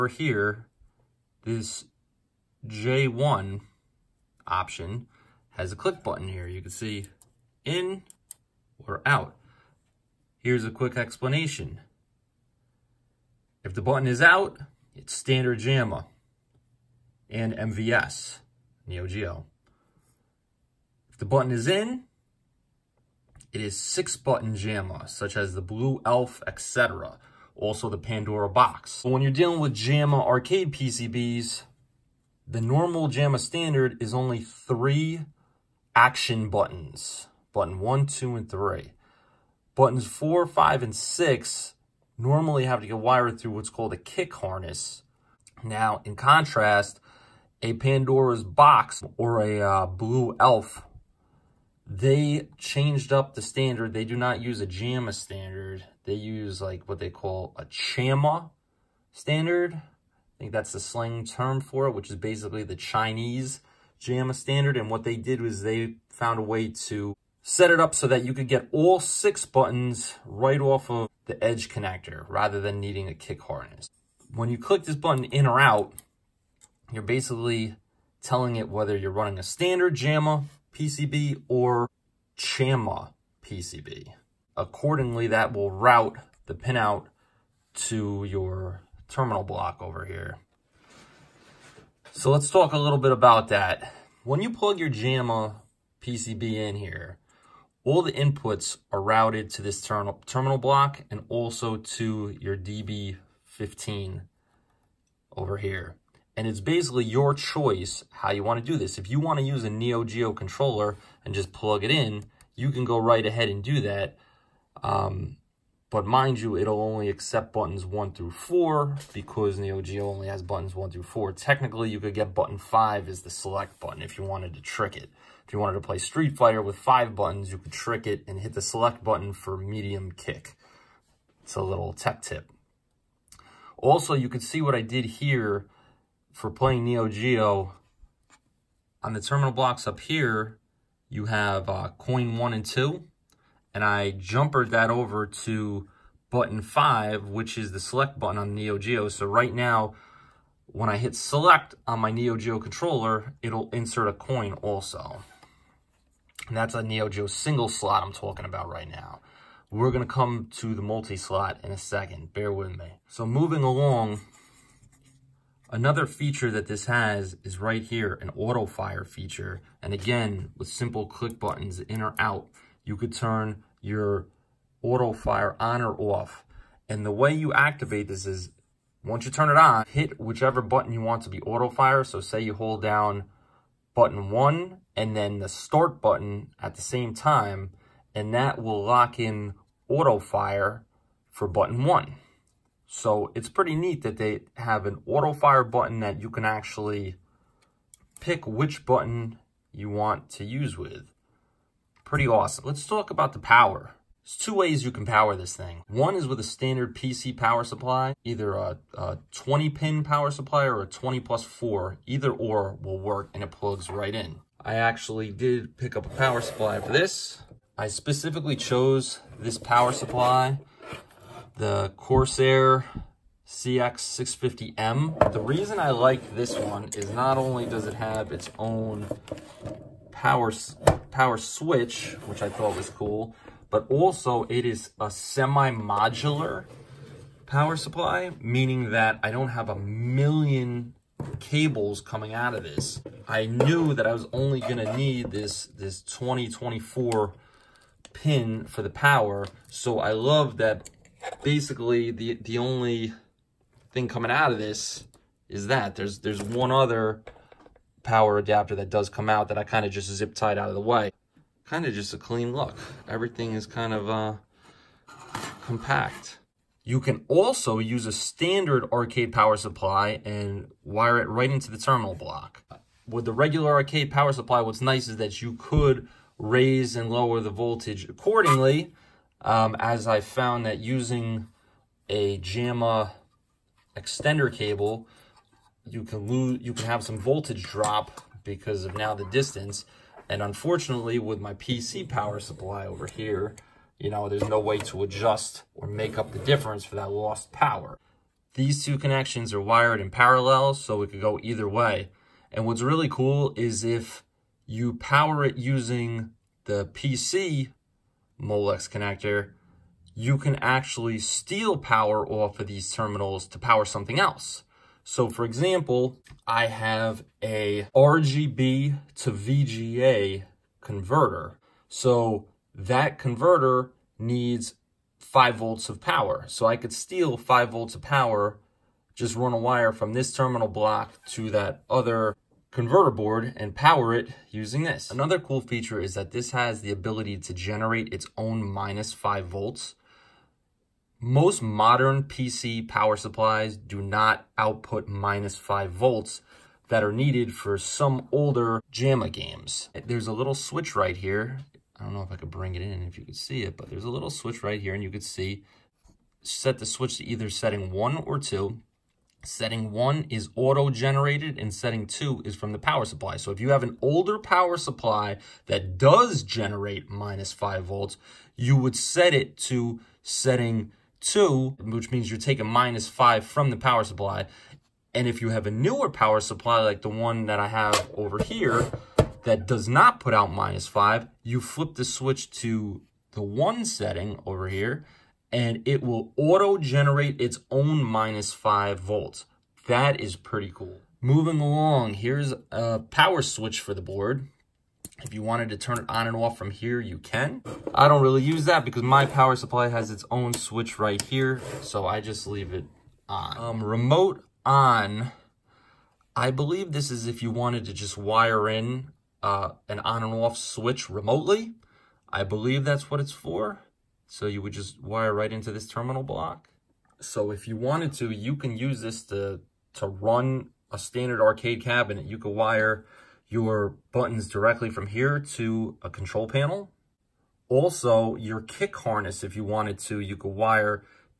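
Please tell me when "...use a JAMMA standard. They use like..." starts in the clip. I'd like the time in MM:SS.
00:54.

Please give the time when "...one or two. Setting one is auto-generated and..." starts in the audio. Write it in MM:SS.
05:57.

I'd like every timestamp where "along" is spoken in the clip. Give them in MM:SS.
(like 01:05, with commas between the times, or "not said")
02:43, 06:31.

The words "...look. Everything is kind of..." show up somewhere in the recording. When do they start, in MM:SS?
04:22.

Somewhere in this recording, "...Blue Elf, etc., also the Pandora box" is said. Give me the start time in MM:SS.
00:25.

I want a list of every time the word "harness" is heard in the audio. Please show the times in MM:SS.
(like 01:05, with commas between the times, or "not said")
00:44, 01:13, 07:08.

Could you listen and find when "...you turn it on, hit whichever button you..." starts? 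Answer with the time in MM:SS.
02:59.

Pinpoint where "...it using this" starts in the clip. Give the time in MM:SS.
05:34.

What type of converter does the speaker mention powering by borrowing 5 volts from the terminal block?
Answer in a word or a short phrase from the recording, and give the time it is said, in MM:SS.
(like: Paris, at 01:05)
RGB to VGA converter, at 05:17.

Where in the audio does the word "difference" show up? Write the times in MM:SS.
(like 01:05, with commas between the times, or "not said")
04:56.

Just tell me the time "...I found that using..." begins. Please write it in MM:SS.
04:40.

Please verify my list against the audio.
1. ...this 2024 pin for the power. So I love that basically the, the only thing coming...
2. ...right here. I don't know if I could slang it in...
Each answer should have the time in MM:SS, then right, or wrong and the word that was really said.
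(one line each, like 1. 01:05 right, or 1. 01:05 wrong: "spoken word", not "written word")
1. 04:05 right
2. 05:50 wrong: "bring", not "slang".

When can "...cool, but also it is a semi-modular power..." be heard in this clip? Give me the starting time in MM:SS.
03:52.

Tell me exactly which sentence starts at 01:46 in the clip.
And it's basically your choice how you want to do this.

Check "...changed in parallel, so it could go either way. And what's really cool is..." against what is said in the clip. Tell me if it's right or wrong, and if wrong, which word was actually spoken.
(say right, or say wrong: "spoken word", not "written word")
wrong: "wired", not "changed".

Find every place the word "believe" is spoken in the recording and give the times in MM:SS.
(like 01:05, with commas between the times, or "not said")
06:46, 06:52.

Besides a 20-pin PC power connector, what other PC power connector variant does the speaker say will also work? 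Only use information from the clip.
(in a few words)
20 plus 4.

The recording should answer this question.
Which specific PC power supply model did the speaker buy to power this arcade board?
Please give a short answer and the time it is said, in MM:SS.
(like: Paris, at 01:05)
Corsair CX650M, at 03:41.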